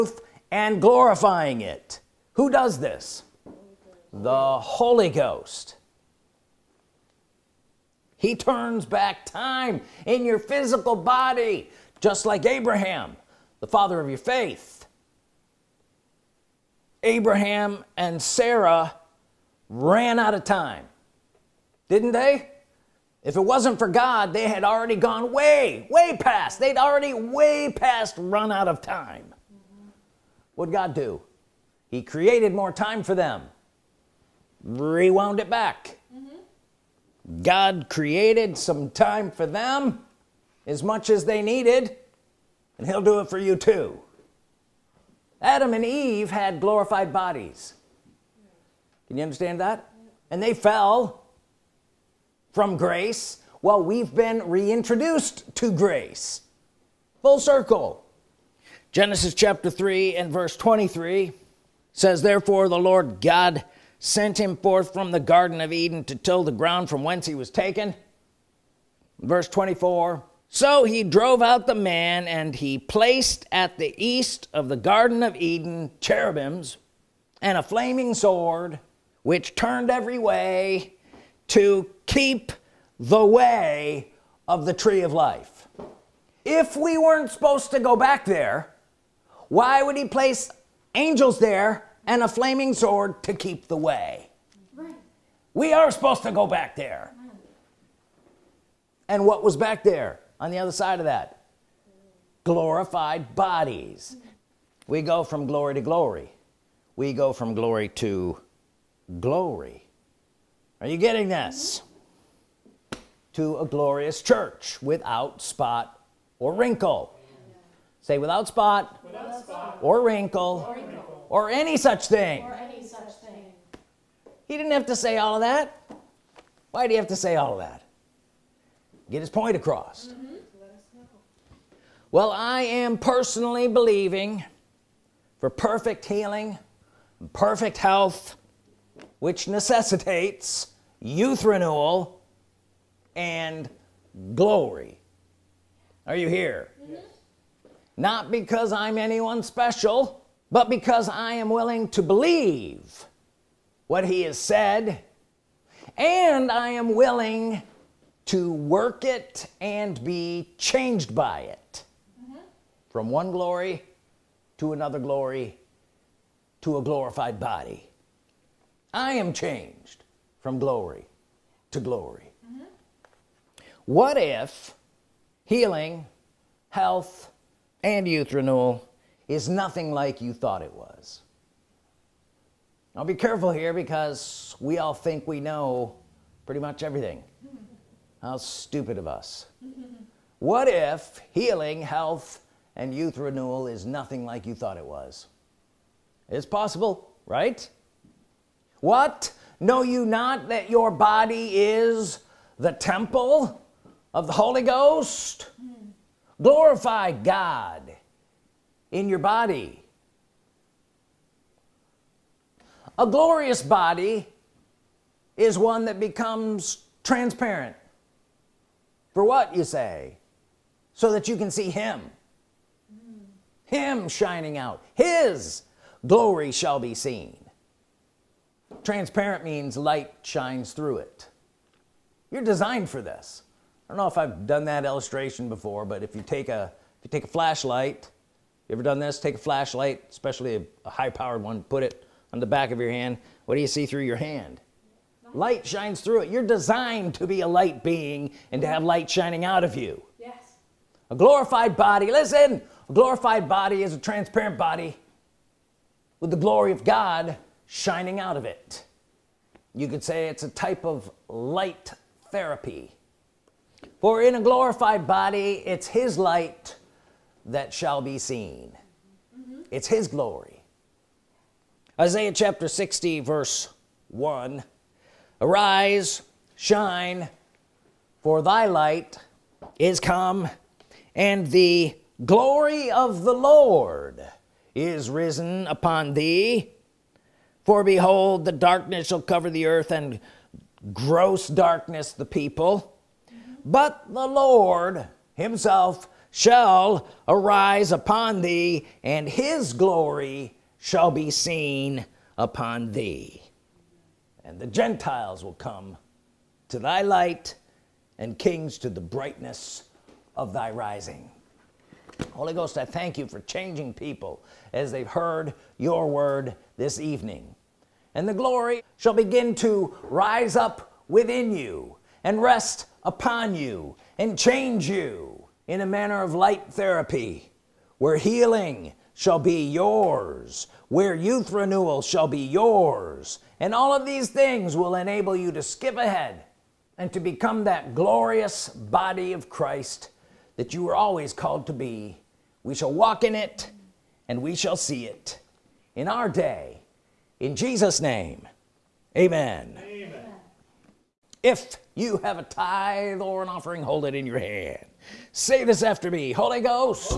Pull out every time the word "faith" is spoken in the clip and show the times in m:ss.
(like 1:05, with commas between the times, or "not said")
0:14.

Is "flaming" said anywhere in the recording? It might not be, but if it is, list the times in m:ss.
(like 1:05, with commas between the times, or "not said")
1:17, 1:32.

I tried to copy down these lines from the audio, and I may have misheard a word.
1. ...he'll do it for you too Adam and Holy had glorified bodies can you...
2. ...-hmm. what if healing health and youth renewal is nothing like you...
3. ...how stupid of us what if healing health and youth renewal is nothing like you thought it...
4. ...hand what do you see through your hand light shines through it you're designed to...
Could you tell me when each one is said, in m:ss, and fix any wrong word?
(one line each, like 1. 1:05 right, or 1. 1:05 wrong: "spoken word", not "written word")
1. 0:42 wrong: "Eve", not "Holy"
2. 2:52 right
3. 3:08 right
4. 4:02 right.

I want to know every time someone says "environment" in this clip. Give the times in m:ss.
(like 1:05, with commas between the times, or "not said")
not said.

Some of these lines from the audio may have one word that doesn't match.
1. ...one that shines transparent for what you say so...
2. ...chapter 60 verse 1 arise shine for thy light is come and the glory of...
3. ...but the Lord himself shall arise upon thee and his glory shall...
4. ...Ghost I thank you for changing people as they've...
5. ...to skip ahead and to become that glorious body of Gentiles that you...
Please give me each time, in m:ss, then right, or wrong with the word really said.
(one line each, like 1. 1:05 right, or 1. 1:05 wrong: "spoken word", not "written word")
1. 3:35 wrong: "becomes", not "shines"
2. 4:32 right
3. 4:53 right
4. 5:12 right
5. 5:35 wrong: "Christ", not "Gentiles".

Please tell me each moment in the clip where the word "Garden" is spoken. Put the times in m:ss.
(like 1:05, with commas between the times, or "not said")
1:05, 1:14.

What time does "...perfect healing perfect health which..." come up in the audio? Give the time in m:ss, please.
2:15.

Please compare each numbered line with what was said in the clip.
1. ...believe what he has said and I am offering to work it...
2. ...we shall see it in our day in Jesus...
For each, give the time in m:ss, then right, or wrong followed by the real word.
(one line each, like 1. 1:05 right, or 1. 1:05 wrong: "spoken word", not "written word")
1. 2:32 wrong: "willing", not "offering"
2. 5:44 right.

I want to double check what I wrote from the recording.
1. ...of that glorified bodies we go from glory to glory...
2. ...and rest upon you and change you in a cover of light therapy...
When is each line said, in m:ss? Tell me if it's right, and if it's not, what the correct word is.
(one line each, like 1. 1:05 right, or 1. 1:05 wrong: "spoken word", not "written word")
1. 1:40 right
2. 5:22 wrong: "manner", not "cover".